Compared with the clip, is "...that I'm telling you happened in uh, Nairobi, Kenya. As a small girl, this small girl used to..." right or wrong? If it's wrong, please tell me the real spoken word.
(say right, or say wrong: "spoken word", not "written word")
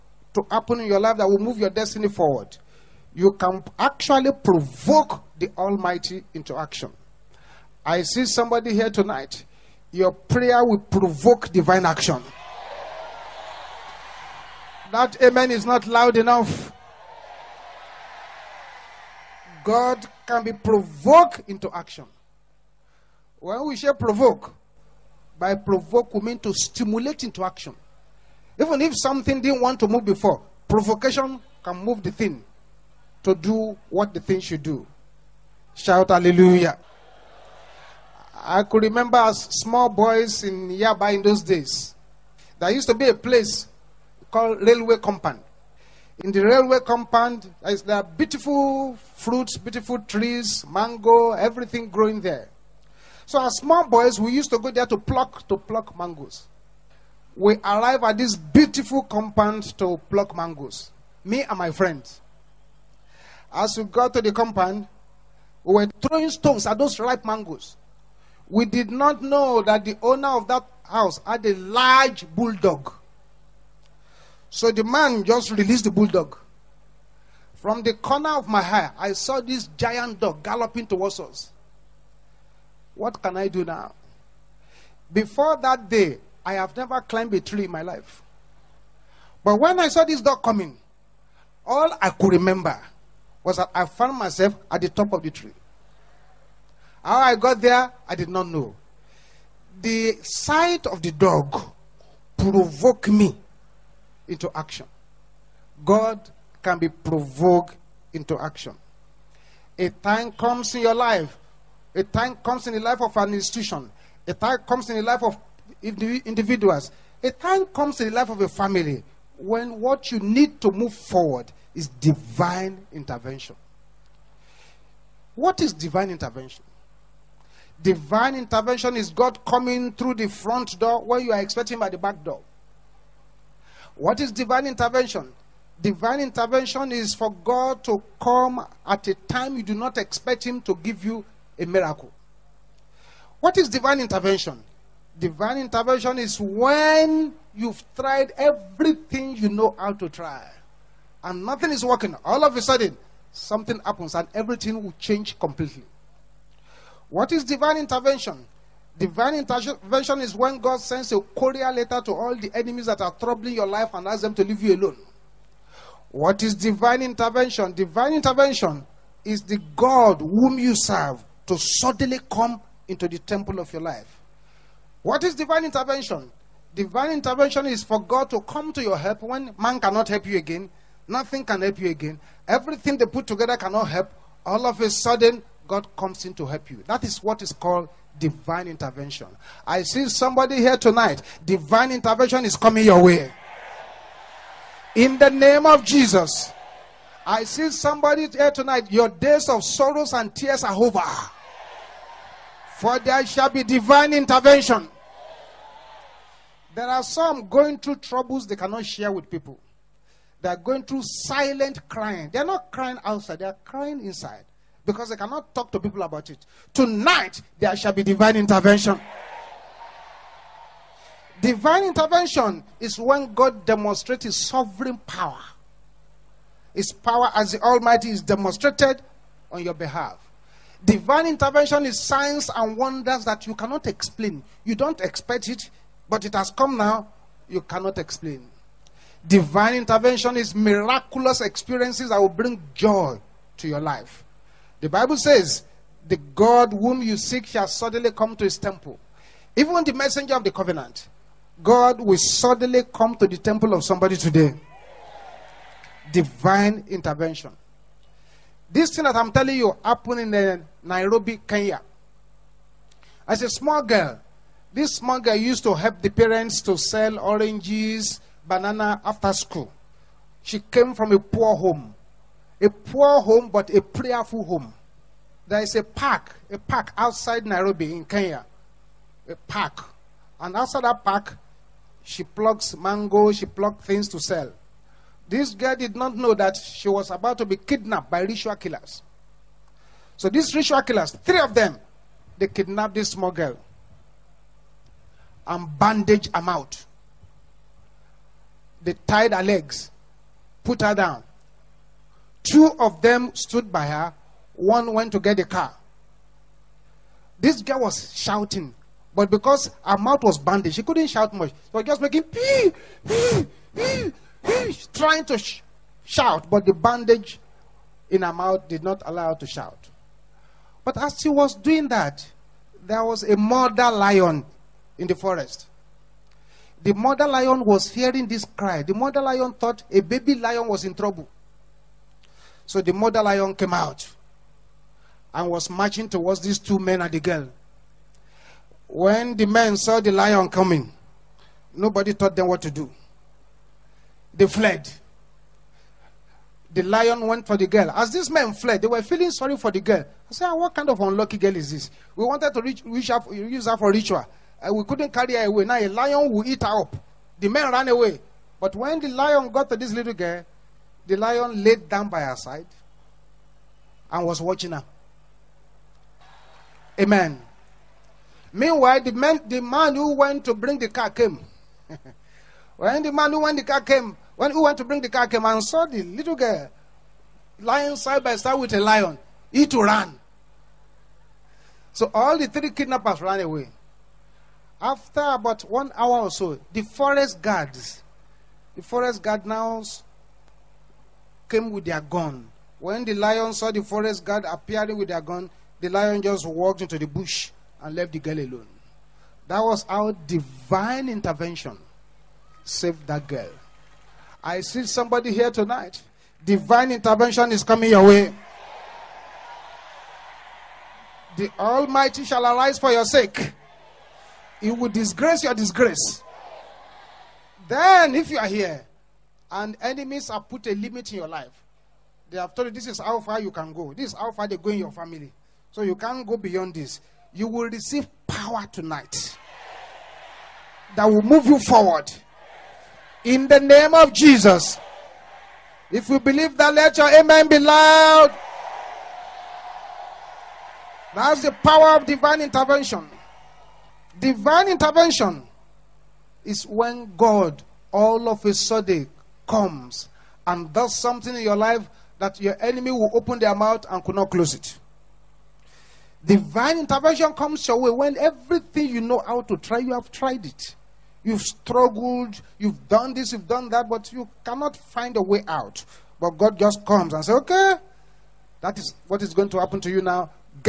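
right.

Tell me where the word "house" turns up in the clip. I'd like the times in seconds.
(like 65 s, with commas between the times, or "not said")
70 s.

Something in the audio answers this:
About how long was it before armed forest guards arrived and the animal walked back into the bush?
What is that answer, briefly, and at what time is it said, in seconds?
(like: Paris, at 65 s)
1 hour, at 385 s.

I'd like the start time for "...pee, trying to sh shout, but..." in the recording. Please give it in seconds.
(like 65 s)
314 s.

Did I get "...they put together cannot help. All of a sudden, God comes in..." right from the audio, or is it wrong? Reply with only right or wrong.
right.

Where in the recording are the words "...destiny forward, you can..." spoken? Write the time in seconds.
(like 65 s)
1 s.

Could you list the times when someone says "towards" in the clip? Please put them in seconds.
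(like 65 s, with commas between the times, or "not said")
80 s, 336 s.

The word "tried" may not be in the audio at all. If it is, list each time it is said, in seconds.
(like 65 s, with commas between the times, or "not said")
147 s, 460 s.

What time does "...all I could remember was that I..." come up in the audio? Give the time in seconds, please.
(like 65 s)
91 s.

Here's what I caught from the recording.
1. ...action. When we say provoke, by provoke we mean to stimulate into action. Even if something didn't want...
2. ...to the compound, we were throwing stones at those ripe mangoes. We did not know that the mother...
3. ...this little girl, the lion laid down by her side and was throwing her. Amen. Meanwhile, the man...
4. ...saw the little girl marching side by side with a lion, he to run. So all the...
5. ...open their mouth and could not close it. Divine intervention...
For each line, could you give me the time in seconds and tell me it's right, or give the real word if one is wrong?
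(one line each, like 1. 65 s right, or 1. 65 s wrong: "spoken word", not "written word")
1. 21 s right
2. 64 s wrong: "owner", not "mother"
3. 359 s wrong: "watching", not "throwing"
4. 375 s wrong: "lying", not "marching"
5. 453 s right.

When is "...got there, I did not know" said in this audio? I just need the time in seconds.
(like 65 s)
97 s.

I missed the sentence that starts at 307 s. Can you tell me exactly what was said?
This girl was shouting, but because her mouth was bandaged, she couldn't shout much.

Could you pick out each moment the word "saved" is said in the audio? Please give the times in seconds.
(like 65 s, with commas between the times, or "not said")
402 s.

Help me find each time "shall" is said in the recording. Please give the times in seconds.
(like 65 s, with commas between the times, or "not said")
203 s, 217 s, 247 s, 412 s.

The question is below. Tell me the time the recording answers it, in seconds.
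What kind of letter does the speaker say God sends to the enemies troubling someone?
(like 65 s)
161 s.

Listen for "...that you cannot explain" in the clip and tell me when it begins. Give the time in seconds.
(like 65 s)
233 s.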